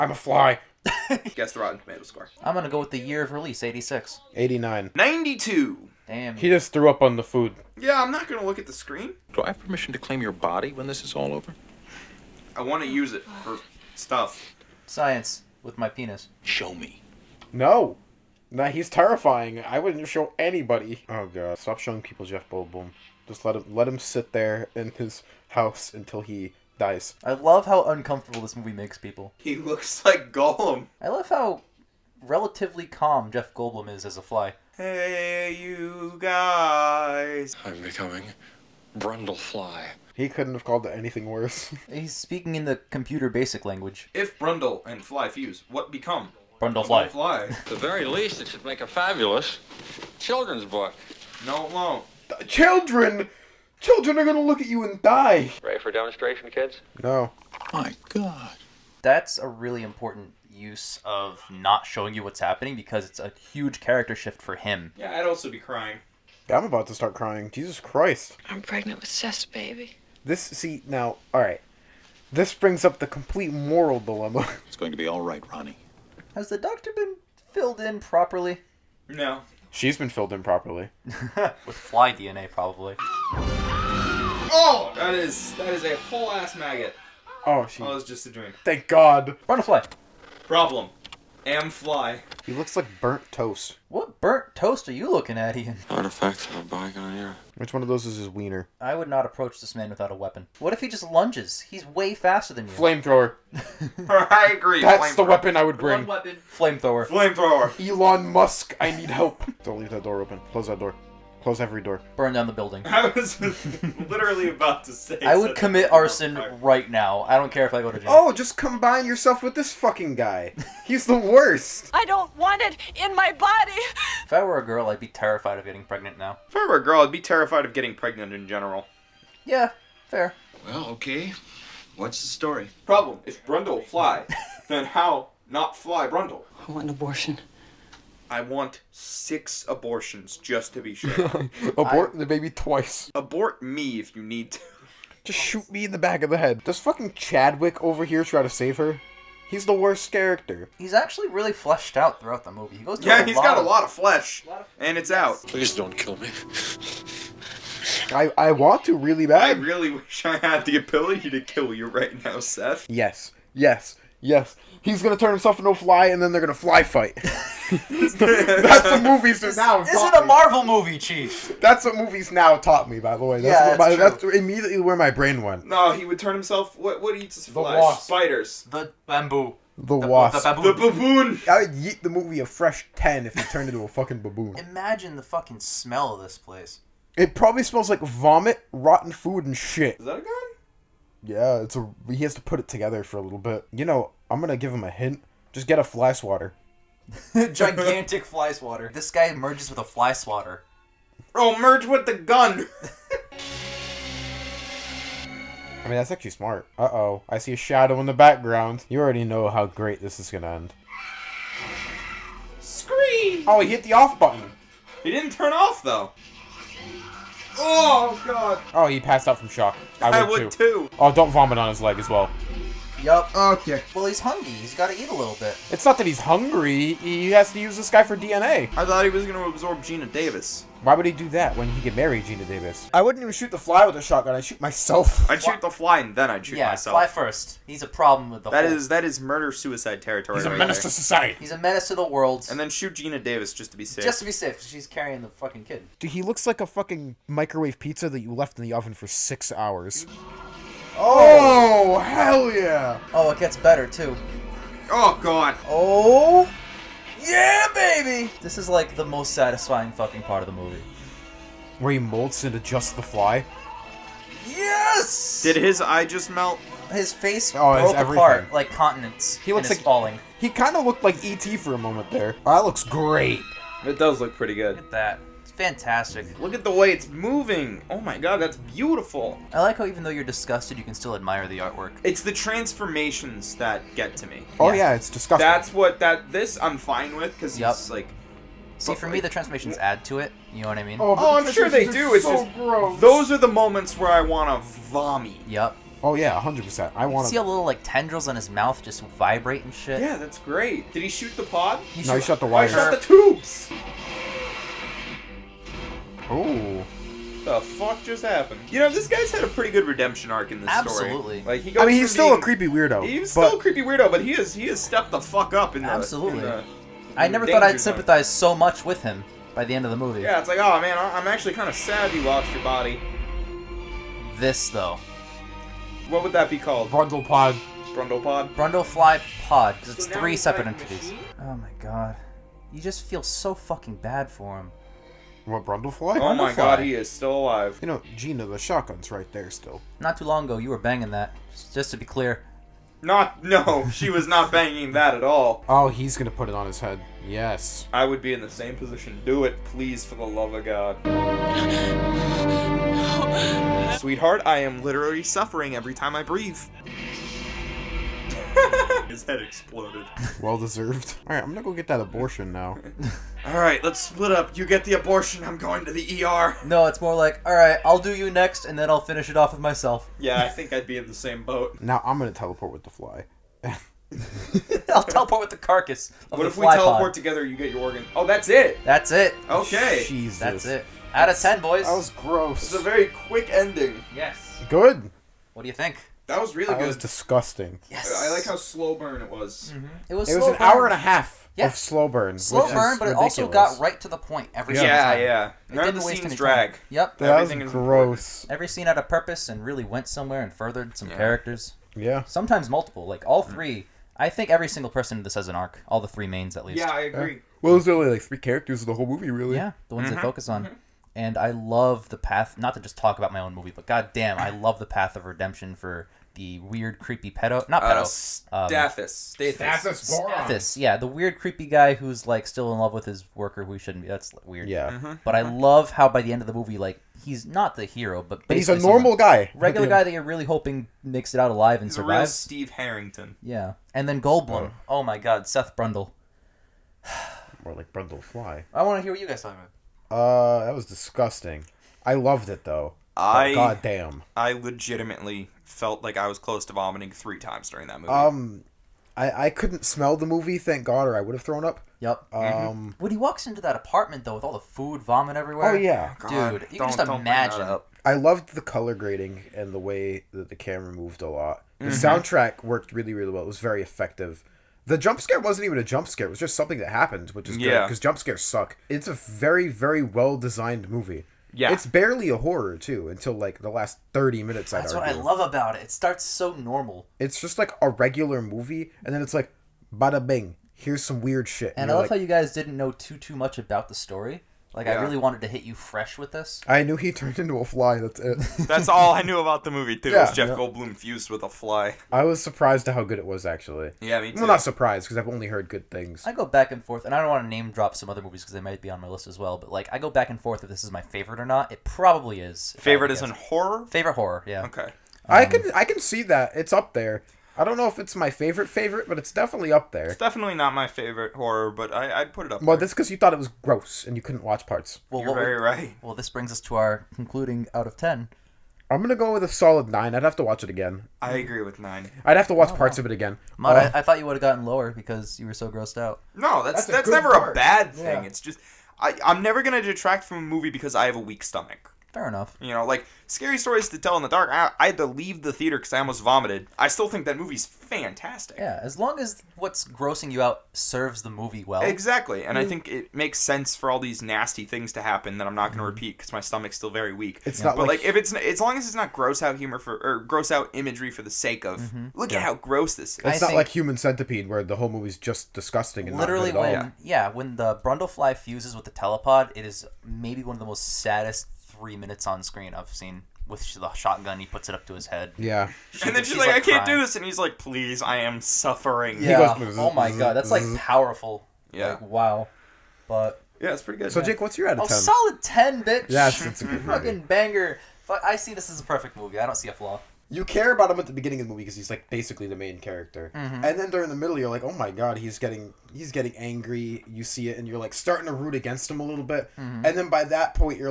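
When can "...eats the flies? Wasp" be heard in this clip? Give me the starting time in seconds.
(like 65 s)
177 s.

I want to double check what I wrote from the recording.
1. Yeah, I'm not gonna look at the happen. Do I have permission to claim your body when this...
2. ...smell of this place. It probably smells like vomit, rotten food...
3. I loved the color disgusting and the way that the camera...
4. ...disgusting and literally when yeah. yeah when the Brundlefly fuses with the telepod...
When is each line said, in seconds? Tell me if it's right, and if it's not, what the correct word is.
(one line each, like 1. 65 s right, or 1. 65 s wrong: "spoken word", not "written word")
1. 7 s wrong: "screen", not "happen"
2. 185 s right
3. 458 s wrong: "grading", not "disgusting"
4. 555 s right.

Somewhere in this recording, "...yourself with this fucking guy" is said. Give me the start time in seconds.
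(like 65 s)
119 s.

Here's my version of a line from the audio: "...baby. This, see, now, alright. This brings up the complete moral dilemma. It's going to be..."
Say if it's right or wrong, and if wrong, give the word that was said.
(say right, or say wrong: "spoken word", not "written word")
right.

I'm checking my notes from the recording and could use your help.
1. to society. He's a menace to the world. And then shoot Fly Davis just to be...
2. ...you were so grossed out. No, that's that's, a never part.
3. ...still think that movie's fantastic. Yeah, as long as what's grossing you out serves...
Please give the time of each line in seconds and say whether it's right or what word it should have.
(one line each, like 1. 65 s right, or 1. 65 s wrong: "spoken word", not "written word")
1. 240 s wrong: "Geena", not "Fly"
2. 525 s right
3. 536 s right.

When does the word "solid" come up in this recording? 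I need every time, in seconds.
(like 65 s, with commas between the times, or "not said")
519 s, 574 s.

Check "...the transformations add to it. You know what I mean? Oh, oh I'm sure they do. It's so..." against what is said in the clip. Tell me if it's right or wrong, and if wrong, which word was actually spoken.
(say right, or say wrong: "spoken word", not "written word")
right.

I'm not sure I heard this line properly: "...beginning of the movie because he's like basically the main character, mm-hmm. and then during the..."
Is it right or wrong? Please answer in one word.
right.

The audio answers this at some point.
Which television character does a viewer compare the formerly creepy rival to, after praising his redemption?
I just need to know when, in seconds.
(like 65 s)
432 s.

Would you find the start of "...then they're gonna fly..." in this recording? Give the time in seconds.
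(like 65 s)
166 s.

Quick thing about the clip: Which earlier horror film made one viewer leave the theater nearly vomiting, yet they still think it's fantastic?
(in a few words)
Scary Stories to Tell in the Dark.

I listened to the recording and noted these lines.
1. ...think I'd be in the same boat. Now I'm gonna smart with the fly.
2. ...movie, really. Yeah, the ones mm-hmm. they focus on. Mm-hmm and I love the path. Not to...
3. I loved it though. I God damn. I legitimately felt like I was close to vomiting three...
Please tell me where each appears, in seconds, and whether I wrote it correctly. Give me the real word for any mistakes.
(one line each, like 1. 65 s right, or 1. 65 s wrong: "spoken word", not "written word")
1. 370 s wrong: "teleport", not "smart"
2. 409 s right
3. 442 s right.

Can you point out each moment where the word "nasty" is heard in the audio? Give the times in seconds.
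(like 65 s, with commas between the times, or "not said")
544 s.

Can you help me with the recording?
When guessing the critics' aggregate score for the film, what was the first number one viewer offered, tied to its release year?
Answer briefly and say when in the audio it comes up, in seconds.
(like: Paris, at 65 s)
86, at 3 s.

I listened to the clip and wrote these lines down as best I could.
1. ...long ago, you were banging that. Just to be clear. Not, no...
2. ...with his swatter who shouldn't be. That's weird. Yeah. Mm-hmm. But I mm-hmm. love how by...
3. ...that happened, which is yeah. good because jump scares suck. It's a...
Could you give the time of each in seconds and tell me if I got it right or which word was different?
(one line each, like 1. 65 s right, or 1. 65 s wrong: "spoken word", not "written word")
1. 340 s right
2. 422 s wrong: "worker", not "swatter"
3. 466 s right.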